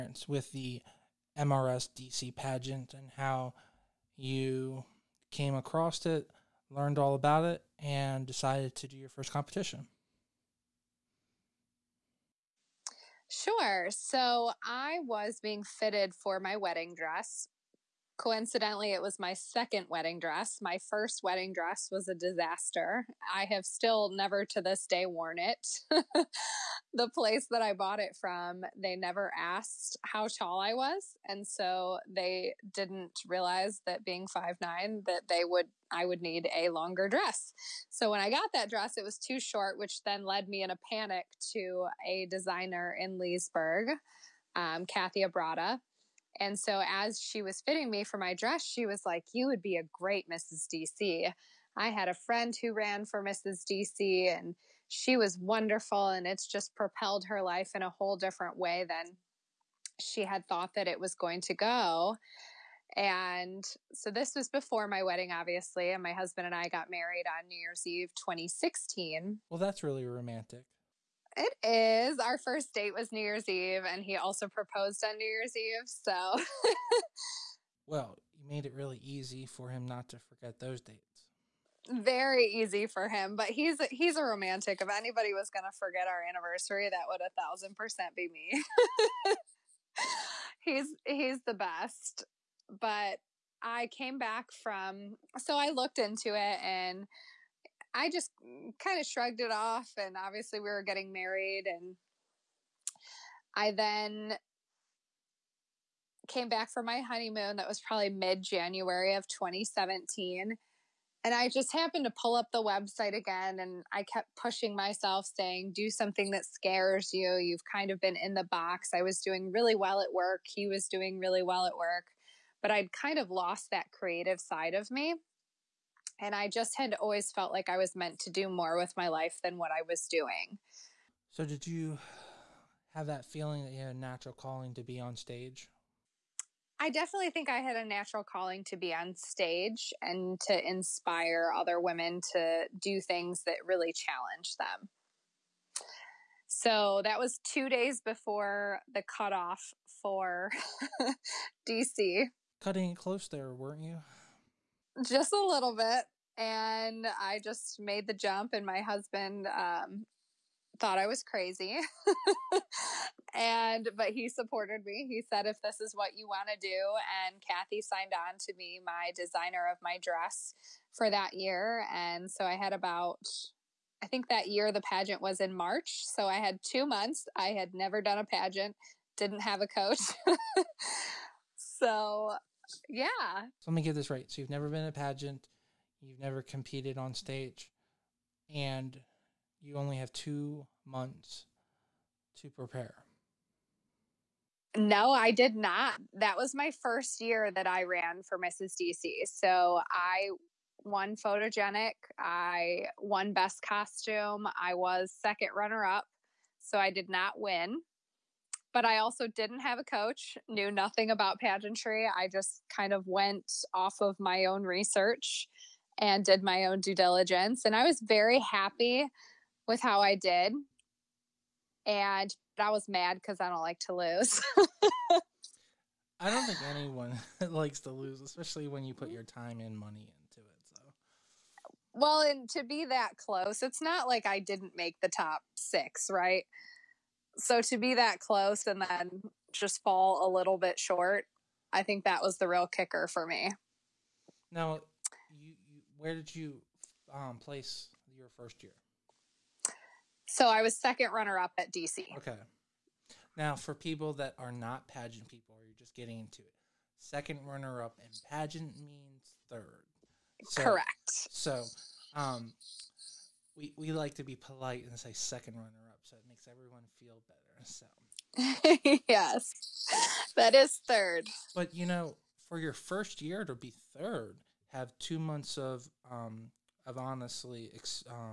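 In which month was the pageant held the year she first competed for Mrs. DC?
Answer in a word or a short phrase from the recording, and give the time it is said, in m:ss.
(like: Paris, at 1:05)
March, at 2:55.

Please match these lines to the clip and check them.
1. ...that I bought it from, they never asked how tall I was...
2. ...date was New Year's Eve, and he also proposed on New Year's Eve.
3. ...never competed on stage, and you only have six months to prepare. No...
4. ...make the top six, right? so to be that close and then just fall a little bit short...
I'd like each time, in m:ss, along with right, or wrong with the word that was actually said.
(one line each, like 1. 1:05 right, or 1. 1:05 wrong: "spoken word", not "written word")
1. 0:27 right
2. 1:12 right
3. 3:06 wrong: "two", not "six"
4. 3:54 right.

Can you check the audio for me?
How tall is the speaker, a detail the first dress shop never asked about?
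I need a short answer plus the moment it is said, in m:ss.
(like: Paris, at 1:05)
5'9, at 0:34.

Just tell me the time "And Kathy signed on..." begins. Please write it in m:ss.
2:47.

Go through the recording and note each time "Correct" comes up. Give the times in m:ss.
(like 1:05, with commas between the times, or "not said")
4:20.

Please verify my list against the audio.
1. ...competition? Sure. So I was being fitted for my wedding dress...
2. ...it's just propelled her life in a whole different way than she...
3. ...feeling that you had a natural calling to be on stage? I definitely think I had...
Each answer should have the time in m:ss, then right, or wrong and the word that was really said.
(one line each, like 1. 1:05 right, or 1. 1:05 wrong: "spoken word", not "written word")
1. 0:09 right
2. 0:56 right
3. 2:13 right.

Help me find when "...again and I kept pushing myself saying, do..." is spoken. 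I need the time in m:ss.
1:53.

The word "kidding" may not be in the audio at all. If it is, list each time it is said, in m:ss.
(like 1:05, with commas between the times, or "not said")
not said.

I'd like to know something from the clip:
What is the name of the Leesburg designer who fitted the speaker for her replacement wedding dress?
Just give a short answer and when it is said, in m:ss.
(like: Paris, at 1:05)
Kathy Abrada, at 0:44.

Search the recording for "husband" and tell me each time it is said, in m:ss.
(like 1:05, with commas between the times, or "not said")
1:06, 2:38.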